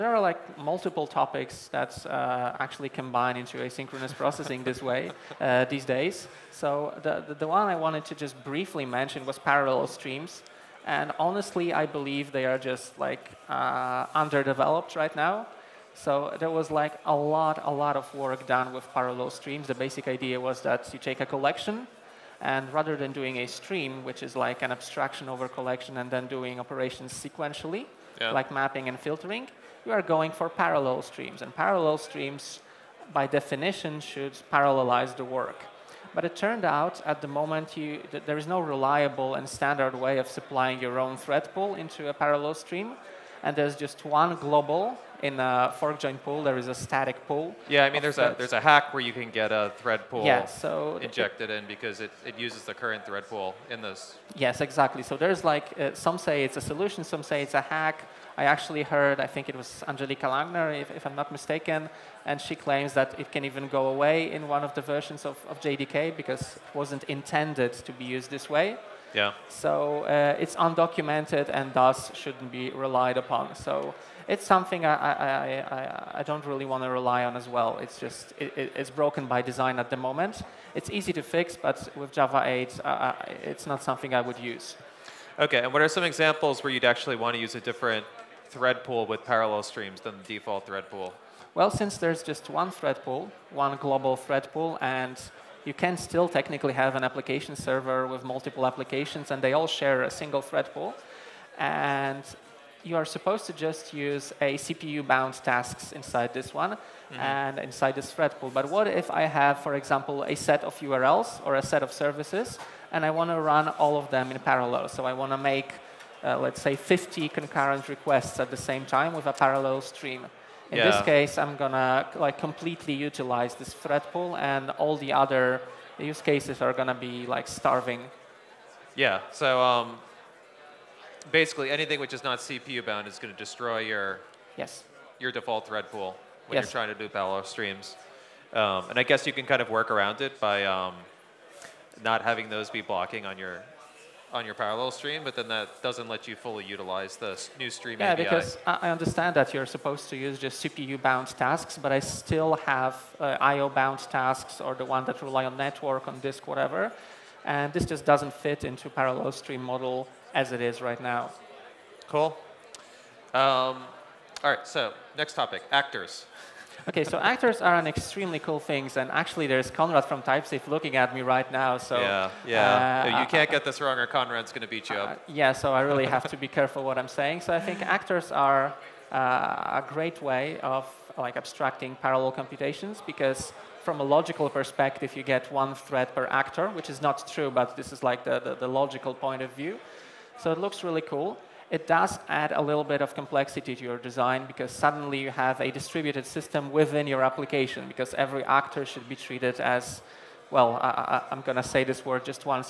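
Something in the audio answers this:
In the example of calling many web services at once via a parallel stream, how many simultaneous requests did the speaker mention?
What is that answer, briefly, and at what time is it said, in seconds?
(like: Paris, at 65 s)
50, at 116 s.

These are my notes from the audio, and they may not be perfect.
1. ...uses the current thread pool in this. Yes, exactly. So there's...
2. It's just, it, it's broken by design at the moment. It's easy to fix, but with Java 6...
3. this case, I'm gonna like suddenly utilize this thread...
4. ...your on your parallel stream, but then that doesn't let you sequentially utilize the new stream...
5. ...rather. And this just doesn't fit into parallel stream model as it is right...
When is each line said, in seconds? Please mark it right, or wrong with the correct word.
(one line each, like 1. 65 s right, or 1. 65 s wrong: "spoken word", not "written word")
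1. 52 s right
2. 77 s wrong: "8", not "6"
3. 120 s wrong: "completely", not "suddenly"
4. 143 s wrong: "fully", not "sequentially"
5. 156 s wrong: "whatever", not "rather".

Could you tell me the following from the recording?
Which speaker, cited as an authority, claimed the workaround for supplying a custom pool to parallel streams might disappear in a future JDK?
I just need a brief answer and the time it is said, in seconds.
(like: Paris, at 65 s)
Angelika Langer, at 59 s.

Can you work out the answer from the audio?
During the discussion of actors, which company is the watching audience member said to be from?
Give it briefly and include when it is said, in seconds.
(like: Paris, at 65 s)
TypeSafe, at 170 s.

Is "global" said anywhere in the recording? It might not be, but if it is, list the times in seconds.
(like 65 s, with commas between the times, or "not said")
44 s, 93 s.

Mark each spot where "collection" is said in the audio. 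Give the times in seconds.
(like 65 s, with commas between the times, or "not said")
21 s, 25 s.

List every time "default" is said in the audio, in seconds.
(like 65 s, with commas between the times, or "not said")
90 s, 135 s.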